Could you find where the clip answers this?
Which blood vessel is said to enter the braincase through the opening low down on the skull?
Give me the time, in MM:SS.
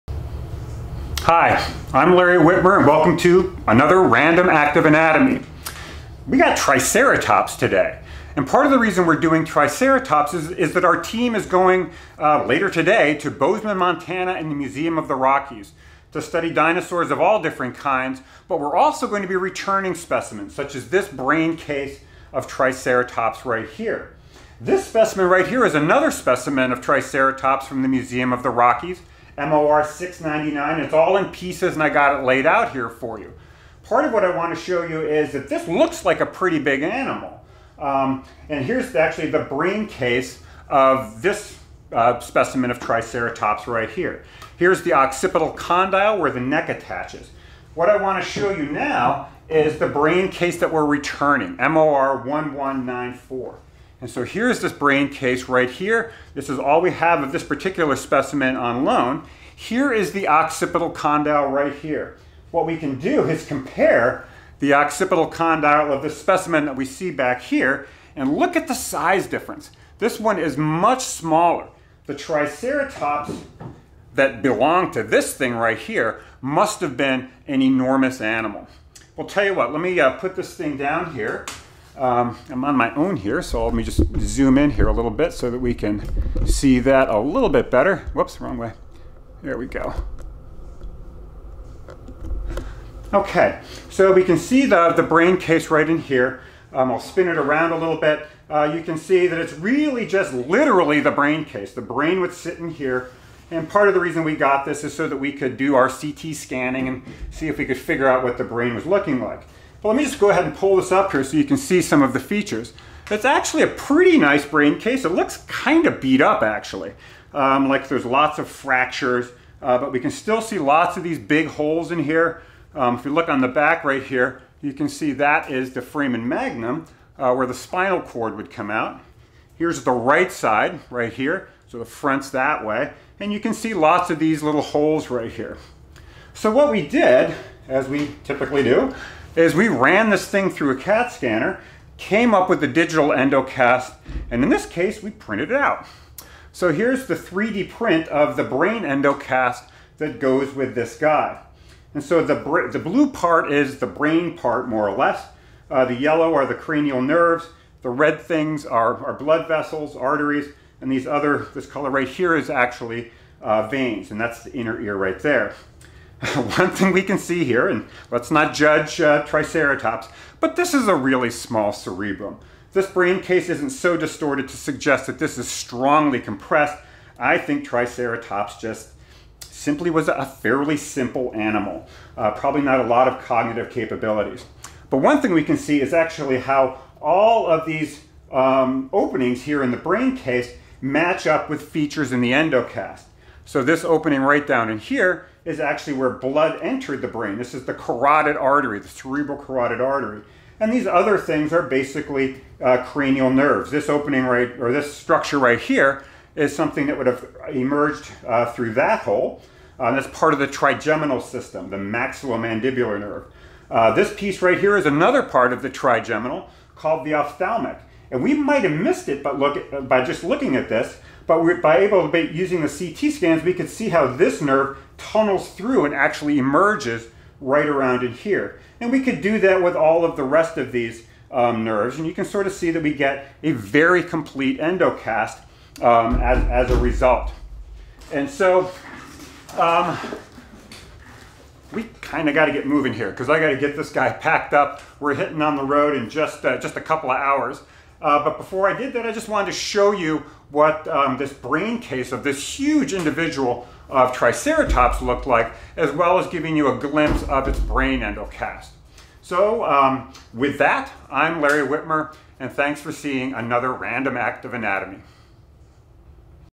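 03:18.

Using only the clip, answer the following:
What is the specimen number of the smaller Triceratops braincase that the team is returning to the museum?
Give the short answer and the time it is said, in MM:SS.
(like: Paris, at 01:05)
MOR 1194, at 00:51.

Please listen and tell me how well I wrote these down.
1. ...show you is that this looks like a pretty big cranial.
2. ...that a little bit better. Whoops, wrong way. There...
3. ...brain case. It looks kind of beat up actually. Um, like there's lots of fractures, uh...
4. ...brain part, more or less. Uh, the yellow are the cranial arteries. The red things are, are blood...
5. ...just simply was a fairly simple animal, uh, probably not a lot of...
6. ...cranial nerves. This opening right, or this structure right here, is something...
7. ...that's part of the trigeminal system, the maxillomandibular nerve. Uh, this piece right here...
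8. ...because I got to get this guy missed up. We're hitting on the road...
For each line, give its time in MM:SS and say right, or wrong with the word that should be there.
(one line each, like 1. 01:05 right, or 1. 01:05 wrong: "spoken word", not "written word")
1. 00:34 wrong: "animal", not "cranial"
2. 01:26 right
3. 01:54 right
4. 02:33 wrong: "nerves", not "arteries"
5. 02:58 right
6. 03:22 right
7. 03:29 right
8. 04:03 wrong: "packed", not "missed".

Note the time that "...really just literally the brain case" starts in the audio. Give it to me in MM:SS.
01:39.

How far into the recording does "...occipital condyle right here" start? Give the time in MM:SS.
01:00.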